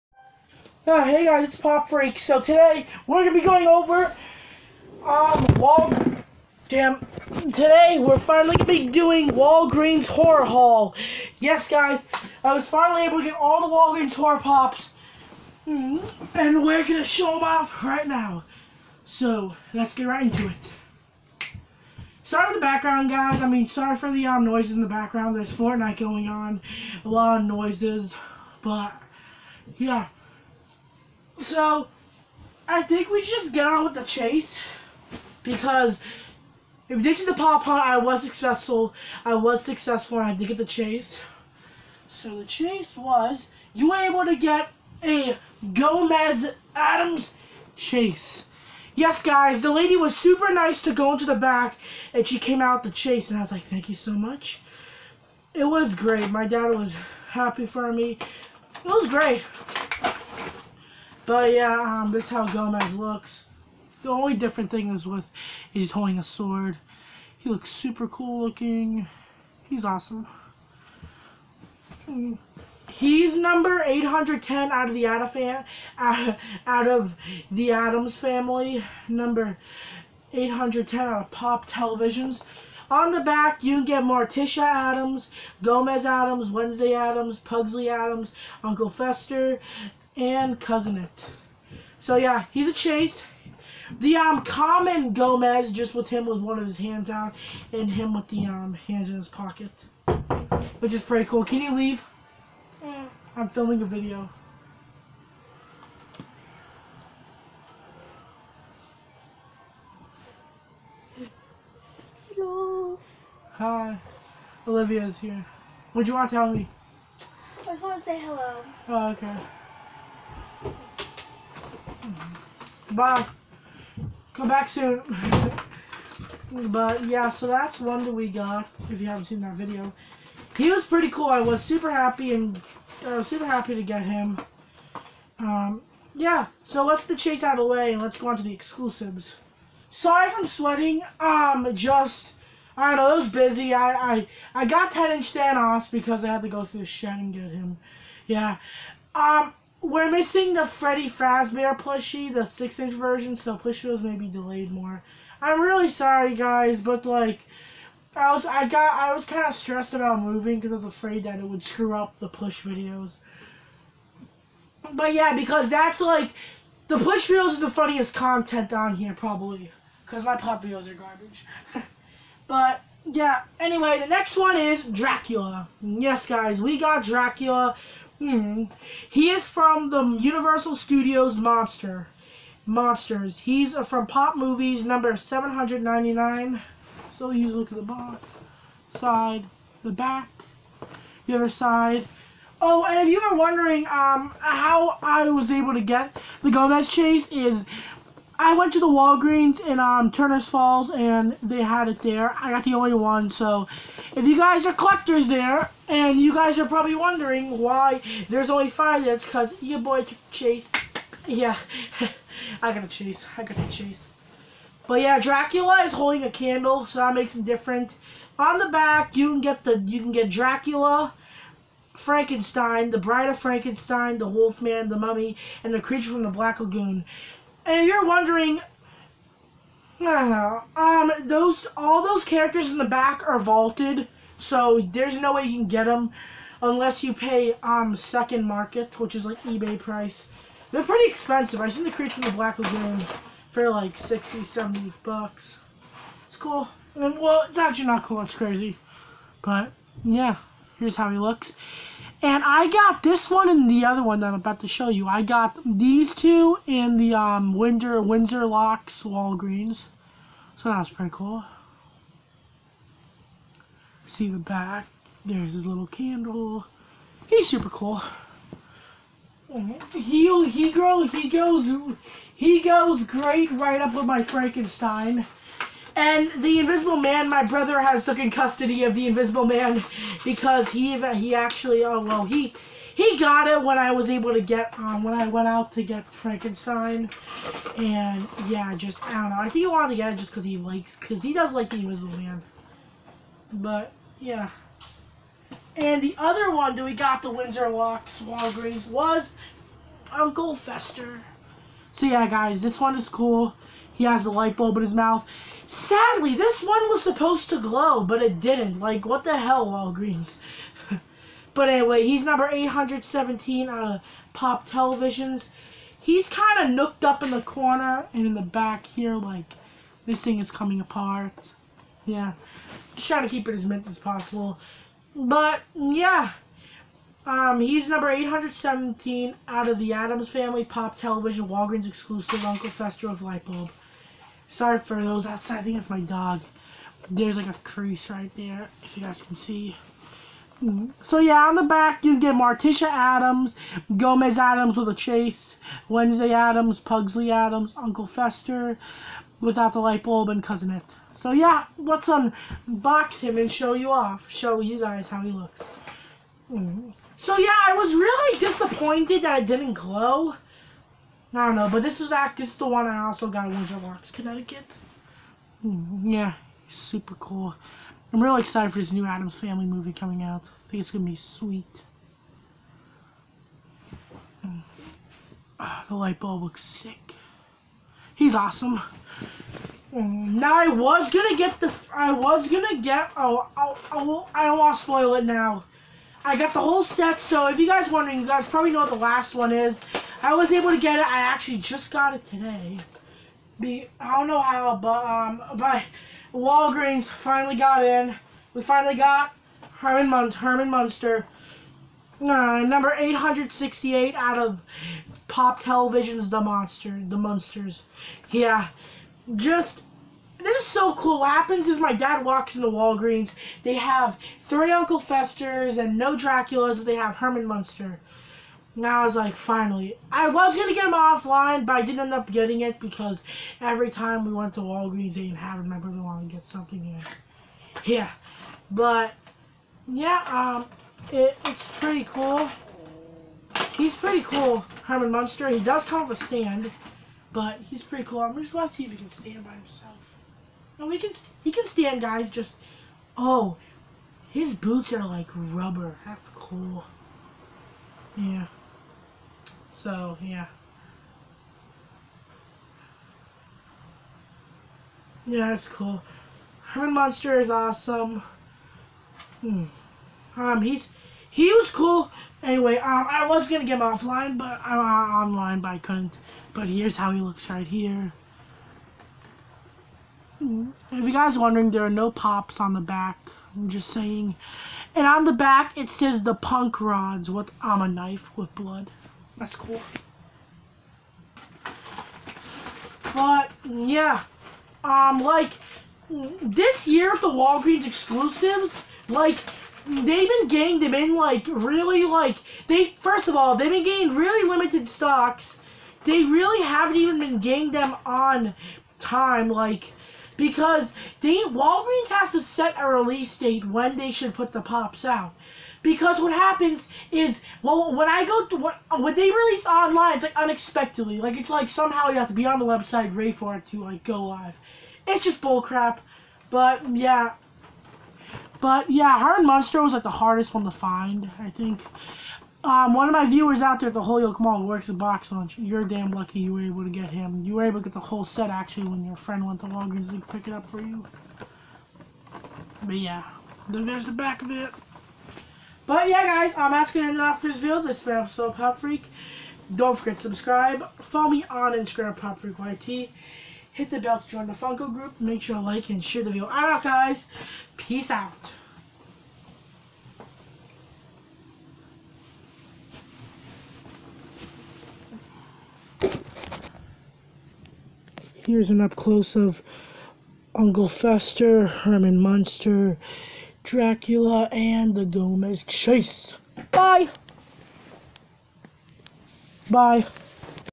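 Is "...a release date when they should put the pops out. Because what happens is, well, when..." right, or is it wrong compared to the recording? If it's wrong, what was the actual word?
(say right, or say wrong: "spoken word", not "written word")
right.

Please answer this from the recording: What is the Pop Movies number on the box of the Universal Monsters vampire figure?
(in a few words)
799.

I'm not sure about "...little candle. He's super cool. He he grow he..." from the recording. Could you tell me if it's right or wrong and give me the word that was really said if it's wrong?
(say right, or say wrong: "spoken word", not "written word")
right.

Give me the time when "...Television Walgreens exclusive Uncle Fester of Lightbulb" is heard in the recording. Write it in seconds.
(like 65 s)
330 s.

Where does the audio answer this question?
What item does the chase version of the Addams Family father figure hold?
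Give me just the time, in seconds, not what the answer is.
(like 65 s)
66 s.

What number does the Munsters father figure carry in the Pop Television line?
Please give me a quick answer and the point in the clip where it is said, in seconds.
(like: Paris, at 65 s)
868, at 402 s.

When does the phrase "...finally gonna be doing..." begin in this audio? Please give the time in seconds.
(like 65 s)
8 s.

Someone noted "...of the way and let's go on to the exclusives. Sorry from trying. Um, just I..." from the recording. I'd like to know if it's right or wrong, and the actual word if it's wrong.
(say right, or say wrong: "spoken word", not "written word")
wrong: "sweating", not "trying".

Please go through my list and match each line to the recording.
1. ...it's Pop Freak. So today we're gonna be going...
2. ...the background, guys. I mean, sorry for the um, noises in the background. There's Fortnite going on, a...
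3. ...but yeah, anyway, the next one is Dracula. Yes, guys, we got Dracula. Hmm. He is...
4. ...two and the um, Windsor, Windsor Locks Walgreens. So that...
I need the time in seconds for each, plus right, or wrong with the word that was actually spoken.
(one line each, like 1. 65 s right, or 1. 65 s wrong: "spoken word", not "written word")
1. 1 s right
2. 22 s right
3. 172 s right
4. 256 s right.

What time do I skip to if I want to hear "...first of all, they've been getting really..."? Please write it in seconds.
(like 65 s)
492 s.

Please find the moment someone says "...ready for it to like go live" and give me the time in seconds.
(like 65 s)
513 s.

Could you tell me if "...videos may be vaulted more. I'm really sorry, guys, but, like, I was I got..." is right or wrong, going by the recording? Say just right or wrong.
wrong.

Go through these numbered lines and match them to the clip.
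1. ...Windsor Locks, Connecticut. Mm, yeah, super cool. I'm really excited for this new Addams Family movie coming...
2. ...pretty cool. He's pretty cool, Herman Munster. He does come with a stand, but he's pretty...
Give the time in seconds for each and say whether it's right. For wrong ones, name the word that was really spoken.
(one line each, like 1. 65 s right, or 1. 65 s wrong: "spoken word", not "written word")
1. 363 s right
2. 431 s right.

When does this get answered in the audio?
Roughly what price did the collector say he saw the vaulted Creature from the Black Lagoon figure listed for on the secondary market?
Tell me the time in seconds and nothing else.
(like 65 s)
243 s.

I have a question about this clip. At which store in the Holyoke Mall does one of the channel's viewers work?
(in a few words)
Box Lunch.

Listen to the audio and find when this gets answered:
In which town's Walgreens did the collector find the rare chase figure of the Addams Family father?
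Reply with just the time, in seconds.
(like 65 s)
200 s.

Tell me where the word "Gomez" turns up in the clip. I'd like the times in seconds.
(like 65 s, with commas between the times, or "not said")
45 s, 62 s, 85 s, 95 s, 196 s, 343 s, 565 s.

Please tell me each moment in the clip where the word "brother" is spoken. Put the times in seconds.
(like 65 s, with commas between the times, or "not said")
277 s, 425 s.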